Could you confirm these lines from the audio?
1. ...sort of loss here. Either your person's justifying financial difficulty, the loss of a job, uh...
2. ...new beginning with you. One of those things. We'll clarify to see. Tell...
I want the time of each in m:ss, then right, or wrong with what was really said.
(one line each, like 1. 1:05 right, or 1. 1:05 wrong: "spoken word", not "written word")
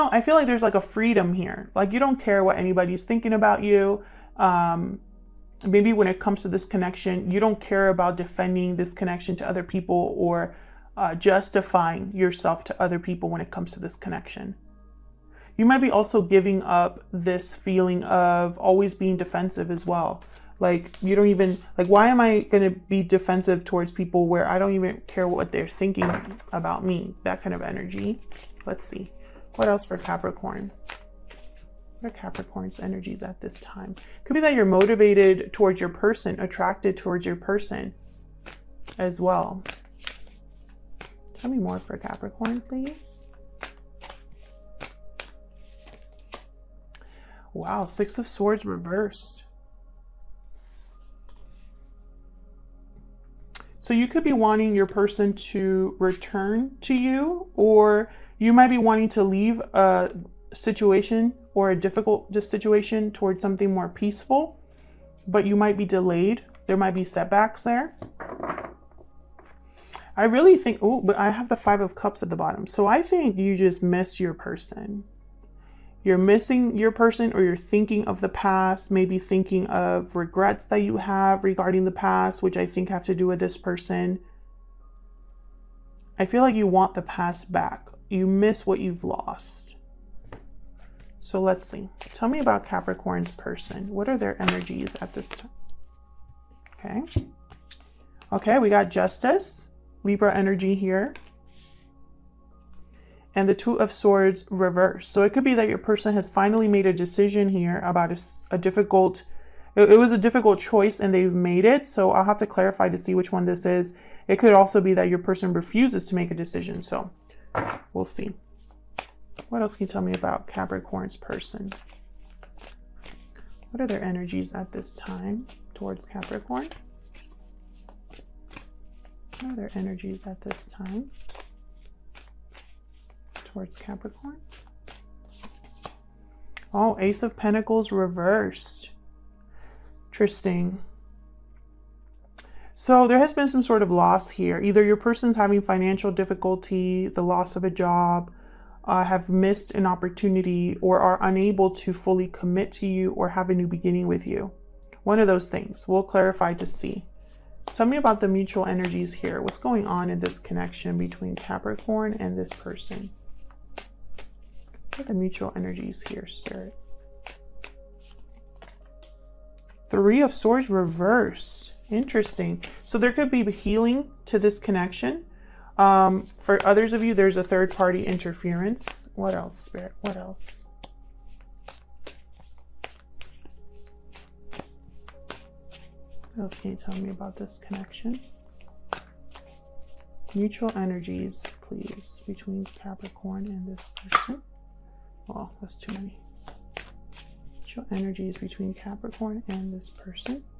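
1. 2:23 wrong: "having", not "justifying"
2. 2:33 right.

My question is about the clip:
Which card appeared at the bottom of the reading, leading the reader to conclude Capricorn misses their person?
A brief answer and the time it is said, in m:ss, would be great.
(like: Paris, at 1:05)
Five of Cups, at 1:11.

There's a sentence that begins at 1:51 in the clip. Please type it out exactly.
So I'll have to clarify to see which one this is.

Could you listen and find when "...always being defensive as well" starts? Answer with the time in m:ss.
0:18.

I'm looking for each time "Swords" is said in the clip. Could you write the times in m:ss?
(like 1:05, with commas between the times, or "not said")
0:48, 1:43, 2:50.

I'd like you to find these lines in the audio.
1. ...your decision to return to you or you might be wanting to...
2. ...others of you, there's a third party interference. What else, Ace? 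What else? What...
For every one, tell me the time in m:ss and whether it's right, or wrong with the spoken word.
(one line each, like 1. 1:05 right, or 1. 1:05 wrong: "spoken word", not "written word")
1. 0:54 wrong: "person", not "decision"
2. 2:56 wrong: "Spirit", not "Ace".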